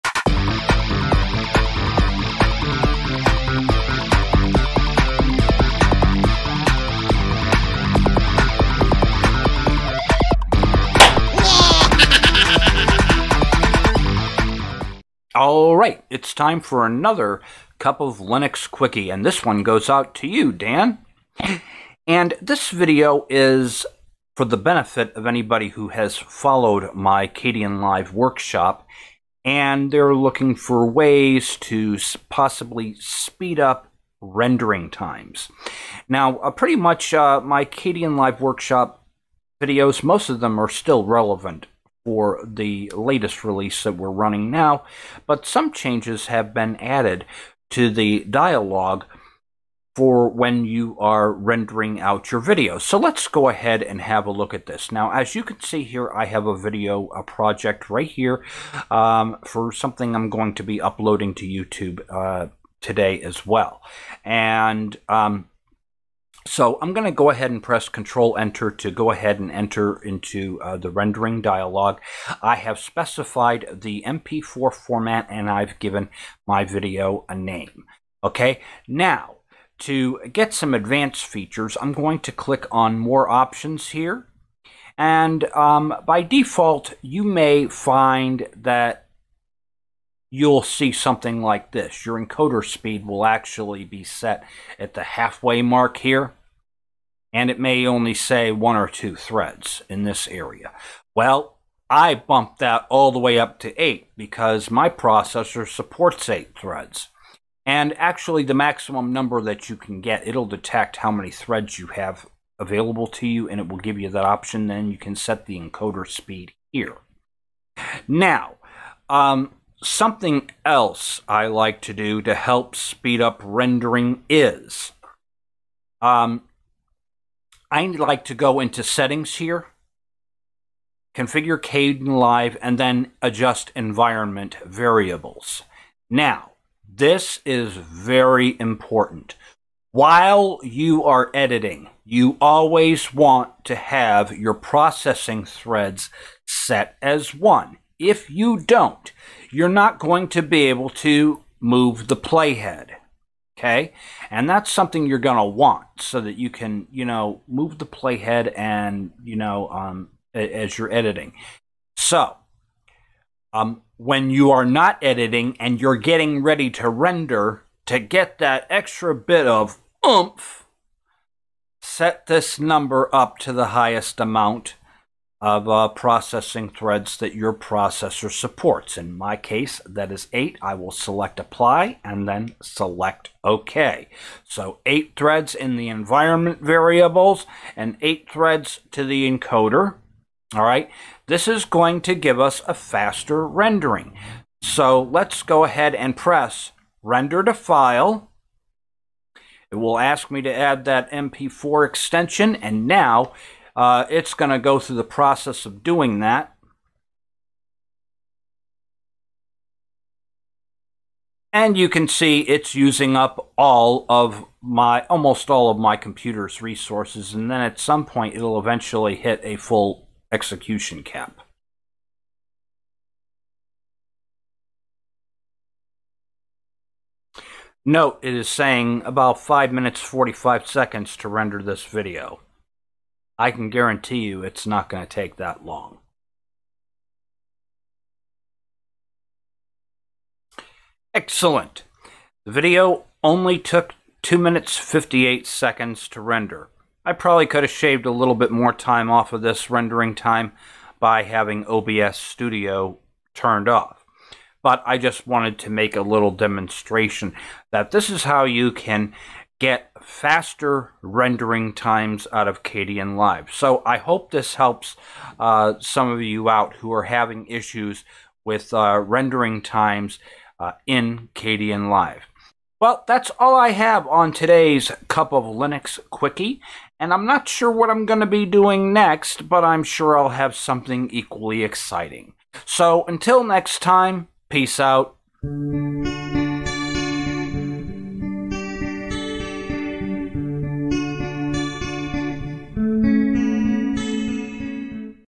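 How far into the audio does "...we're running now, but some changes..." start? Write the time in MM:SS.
00:43.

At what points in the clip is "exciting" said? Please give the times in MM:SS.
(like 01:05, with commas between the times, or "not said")
04:41.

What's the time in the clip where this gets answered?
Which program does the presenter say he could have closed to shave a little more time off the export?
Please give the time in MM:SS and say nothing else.
04:11.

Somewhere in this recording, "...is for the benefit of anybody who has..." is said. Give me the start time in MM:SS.
00:23.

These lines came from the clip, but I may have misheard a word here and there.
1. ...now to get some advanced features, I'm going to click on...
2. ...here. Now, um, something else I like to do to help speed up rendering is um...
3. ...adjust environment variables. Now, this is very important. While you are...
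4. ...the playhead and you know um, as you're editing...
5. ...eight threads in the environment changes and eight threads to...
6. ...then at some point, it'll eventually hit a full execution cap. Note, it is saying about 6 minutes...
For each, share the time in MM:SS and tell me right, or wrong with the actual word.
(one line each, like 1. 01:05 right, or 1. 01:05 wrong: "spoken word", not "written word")
1. 01:18 right
2. 01:56 right
3. 02:13 right
4. 02:37 right
5. 03:04 wrong: "variables", not "changes"
6. 03:37 wrong: "5", not "6".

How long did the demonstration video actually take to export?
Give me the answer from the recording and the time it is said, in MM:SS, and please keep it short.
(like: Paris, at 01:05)
2 minutes 58 seconds, at 04:04.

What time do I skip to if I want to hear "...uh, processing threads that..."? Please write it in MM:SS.
02:55.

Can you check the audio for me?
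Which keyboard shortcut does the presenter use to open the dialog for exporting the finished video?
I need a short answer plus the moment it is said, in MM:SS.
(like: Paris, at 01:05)
Control Enter, at 01:07.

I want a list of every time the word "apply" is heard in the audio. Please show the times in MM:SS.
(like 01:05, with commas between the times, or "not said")
03:01.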